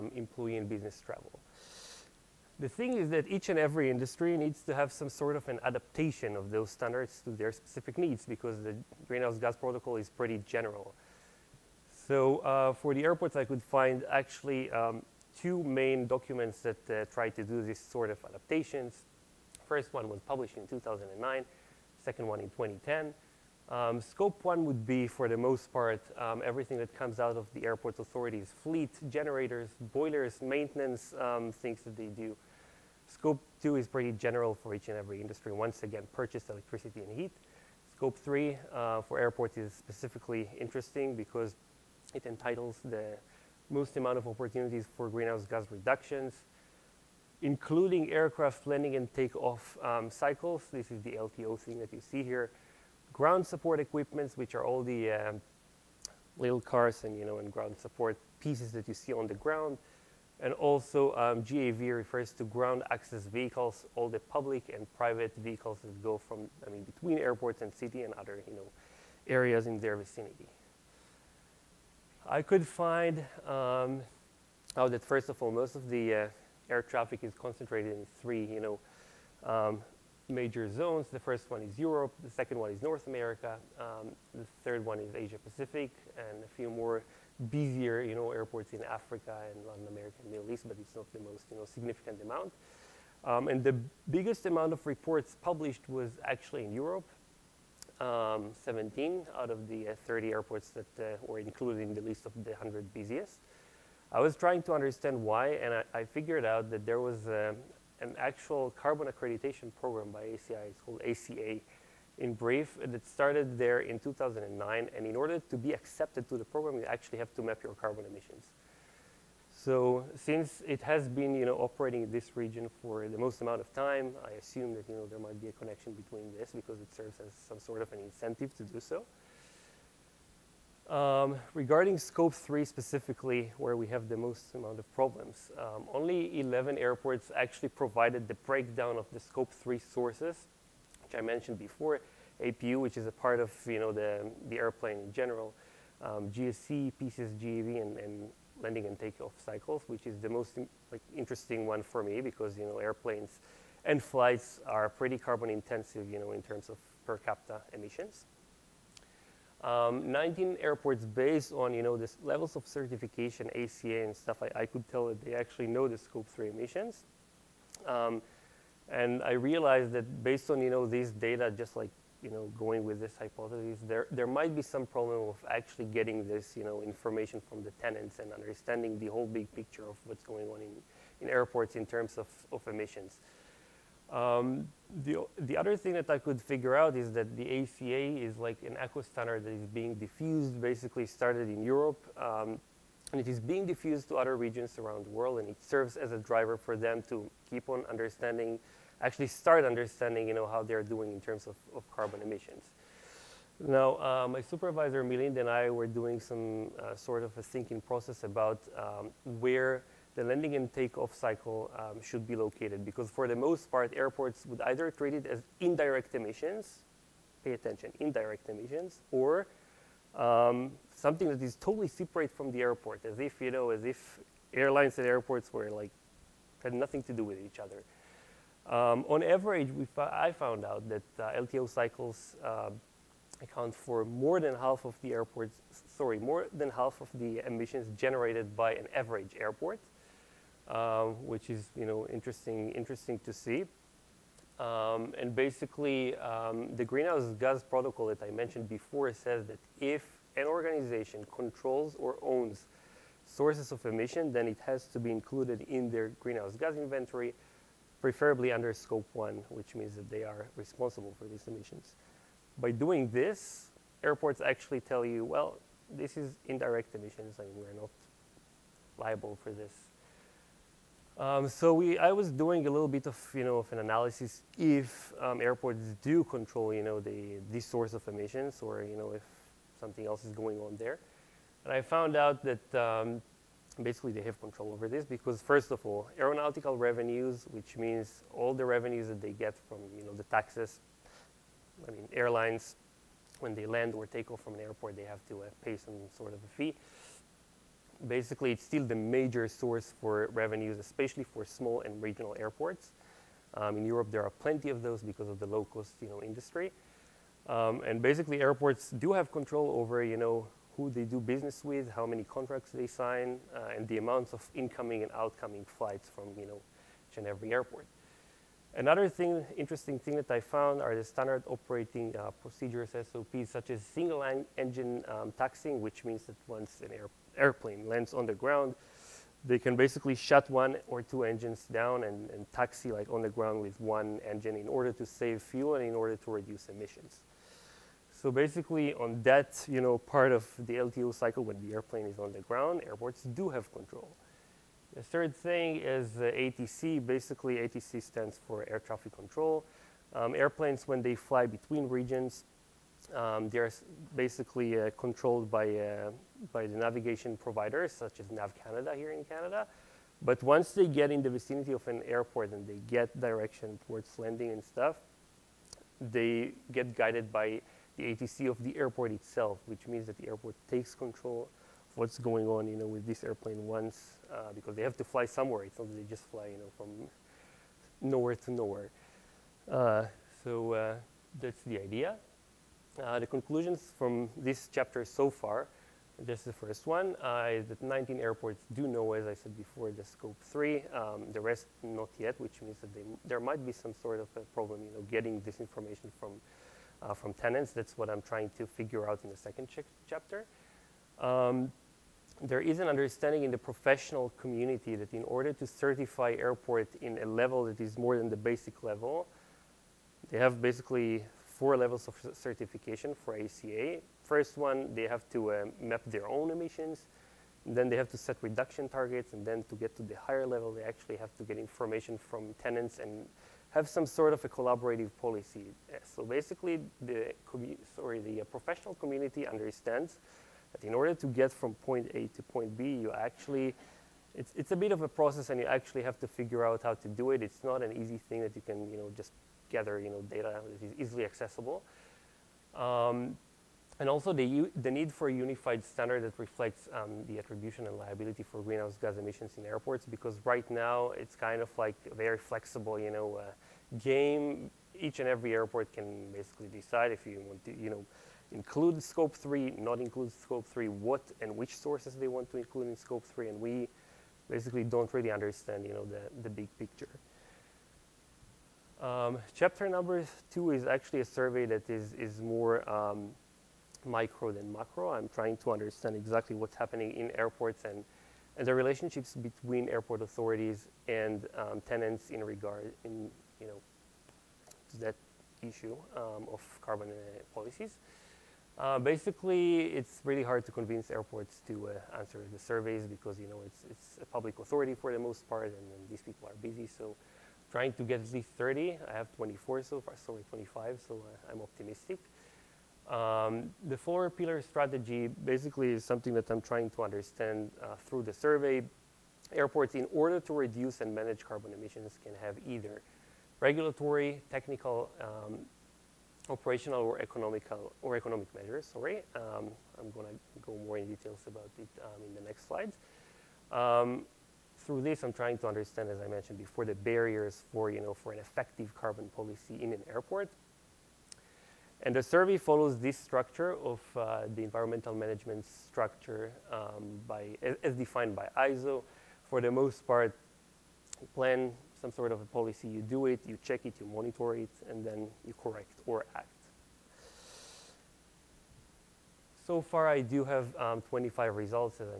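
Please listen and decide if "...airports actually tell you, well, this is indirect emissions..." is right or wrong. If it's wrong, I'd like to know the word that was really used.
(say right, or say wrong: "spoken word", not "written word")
right.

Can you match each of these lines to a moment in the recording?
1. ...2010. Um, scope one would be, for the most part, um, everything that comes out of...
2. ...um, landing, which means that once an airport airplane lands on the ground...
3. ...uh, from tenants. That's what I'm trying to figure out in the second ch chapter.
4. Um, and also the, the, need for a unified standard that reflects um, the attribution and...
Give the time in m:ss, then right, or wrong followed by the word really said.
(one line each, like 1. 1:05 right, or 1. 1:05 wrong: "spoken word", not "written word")
1. 0:22 right
2. 5:25 wrong: "taxing", not "landing"
3. 6:37 right
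4. 7:22 right.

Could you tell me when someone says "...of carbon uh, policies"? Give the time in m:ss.
8:06.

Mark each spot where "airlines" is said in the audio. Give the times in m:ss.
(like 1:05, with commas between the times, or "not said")
3:44, 4:52.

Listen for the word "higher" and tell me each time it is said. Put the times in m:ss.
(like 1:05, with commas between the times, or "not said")
7:00.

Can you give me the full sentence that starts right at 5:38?
So basically on that you know, part of the LTO cycle when the airplane is on the ground, airports do have control.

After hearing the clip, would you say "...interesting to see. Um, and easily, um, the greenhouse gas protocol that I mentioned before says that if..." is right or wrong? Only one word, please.
wrong.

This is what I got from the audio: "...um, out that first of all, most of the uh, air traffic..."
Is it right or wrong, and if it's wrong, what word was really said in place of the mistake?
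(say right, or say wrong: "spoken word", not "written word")
right.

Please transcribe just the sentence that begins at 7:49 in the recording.
Um, chapter number two is actually a survey that is, is more um, micro than macro.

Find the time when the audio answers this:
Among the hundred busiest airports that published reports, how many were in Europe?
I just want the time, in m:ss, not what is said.
1:38.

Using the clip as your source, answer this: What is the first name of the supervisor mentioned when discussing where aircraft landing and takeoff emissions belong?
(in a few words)
Milind.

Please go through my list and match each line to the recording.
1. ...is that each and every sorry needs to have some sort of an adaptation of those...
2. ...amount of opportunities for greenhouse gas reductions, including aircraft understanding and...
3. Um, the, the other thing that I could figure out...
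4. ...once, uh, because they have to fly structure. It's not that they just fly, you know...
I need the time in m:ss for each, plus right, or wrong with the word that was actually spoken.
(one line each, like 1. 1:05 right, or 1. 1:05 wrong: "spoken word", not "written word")
1. 0:02 wrong: "industry", not "sorry"
2. 0:43 wrong: "landing", not "understanding"
3. 3:04 right
4. 6:13 wrong: "somewhere", not "structure".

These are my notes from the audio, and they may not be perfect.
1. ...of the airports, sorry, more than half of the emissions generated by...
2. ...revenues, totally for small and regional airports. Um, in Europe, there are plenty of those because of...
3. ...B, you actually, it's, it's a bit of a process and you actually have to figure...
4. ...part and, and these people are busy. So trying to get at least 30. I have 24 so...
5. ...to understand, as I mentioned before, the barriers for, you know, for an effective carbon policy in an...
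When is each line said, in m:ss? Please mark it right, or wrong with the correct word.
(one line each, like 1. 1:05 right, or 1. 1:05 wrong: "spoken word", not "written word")
1. 3:54 right
2. 5:00 wrong: "especially", not "totally"
3. 7:12 right
4. 8:15 right
5. 8:45 right.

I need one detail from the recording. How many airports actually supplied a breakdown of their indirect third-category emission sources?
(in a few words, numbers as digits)
11.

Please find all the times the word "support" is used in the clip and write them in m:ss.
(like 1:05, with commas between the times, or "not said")
0:53, 0:57.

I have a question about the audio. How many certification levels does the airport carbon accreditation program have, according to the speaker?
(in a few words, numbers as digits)
4.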